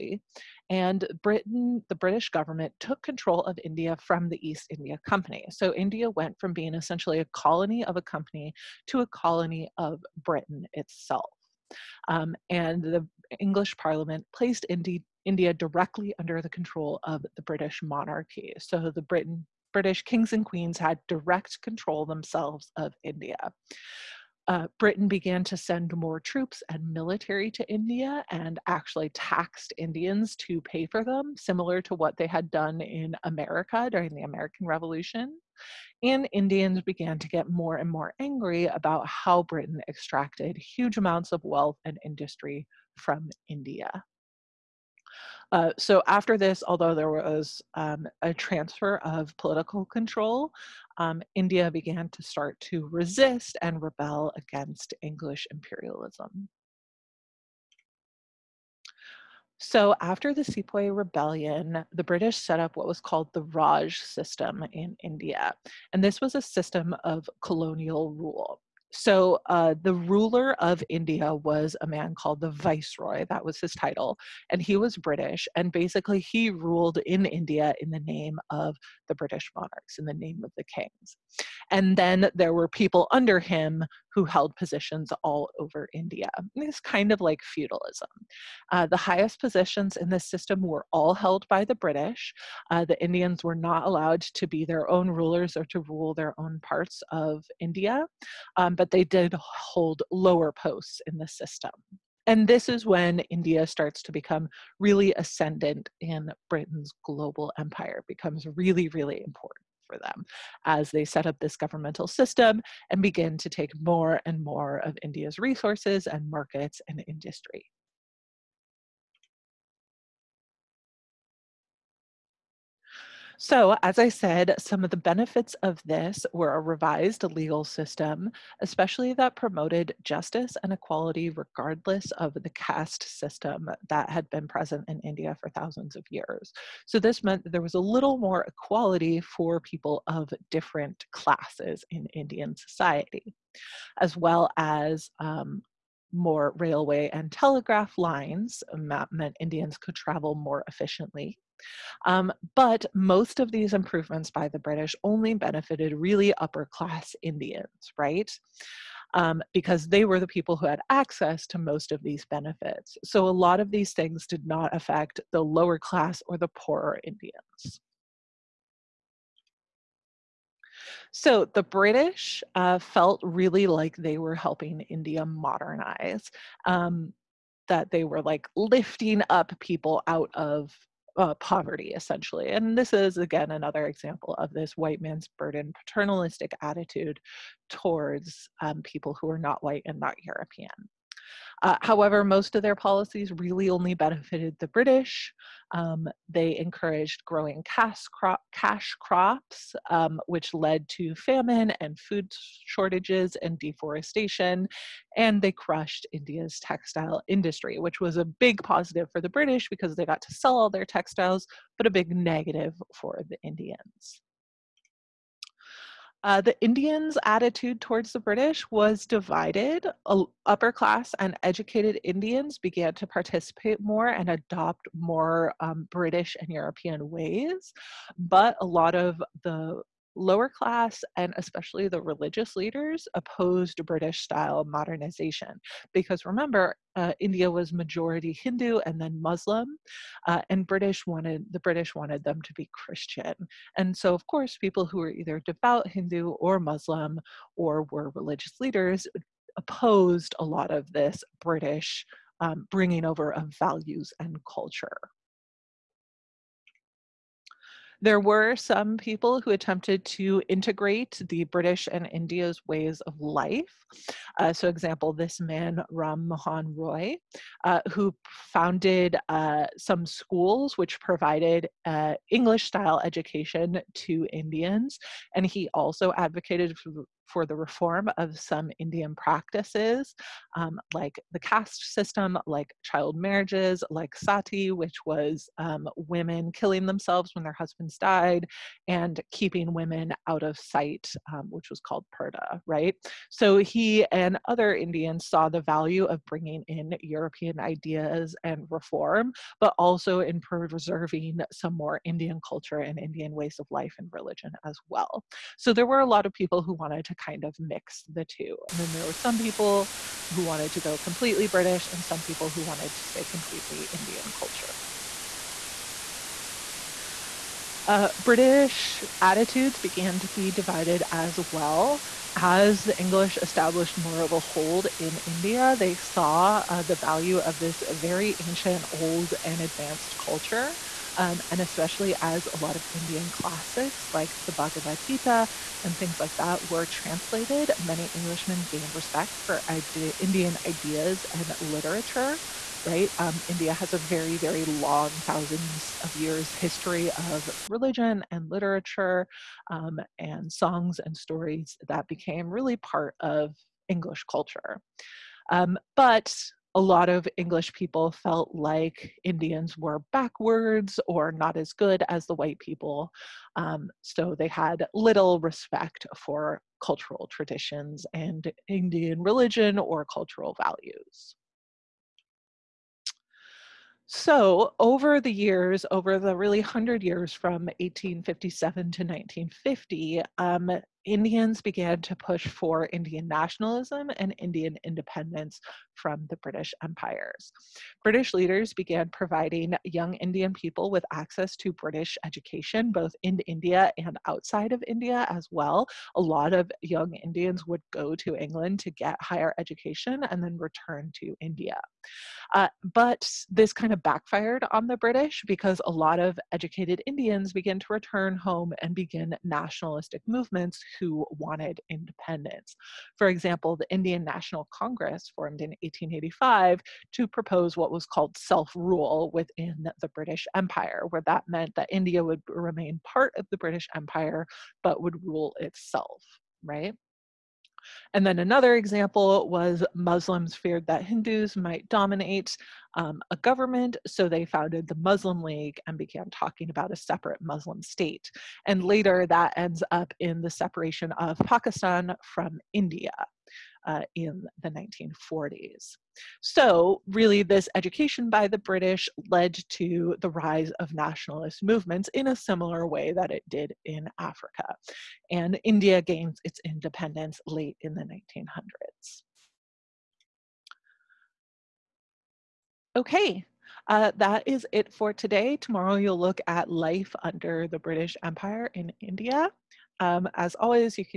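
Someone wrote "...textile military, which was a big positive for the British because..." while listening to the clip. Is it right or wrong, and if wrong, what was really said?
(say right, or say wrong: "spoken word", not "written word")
wrong: "industry", not "military".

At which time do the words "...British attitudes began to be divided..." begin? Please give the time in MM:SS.
05:18.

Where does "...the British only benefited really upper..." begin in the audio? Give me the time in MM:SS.
02:34.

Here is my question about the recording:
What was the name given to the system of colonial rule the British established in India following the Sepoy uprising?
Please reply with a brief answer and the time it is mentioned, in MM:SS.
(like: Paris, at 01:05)
Raj system, at 01:03.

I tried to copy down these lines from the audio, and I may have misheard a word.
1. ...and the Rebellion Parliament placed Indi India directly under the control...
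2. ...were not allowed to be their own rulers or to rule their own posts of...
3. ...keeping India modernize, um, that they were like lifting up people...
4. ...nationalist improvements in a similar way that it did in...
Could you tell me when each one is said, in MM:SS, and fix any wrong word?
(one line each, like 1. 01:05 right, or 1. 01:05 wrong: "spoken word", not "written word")
1. 00:12 wrong: "English", not "Rebellion"
2. 01:33 wrong: "parts", not "posts"
3. 02:54 wrong: "helping", not "keeping"
4. 07:30 wrong: "movements", not "improvements".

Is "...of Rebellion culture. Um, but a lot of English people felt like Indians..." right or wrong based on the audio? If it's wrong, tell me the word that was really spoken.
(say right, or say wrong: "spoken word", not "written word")
wrong: "English", not "Rebellion".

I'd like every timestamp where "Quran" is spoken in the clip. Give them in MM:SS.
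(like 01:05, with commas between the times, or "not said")
not said.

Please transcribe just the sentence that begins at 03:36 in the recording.
Uh, the Indians' attitude towards the British was divided.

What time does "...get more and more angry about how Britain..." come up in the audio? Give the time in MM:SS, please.
00:37.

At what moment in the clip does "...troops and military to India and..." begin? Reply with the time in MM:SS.
00:26.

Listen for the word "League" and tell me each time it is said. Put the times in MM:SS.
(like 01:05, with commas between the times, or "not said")
07:15.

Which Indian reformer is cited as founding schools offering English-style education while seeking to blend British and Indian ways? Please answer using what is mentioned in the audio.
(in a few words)
Ram Mohan Roy.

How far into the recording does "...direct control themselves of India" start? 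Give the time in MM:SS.
00:21.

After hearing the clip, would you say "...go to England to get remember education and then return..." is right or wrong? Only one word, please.
wrong.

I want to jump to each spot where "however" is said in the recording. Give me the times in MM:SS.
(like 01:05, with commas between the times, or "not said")
03:11.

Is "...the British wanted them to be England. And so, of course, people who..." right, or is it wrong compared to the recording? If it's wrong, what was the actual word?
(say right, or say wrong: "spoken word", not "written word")
wrong: "Christian", not "England".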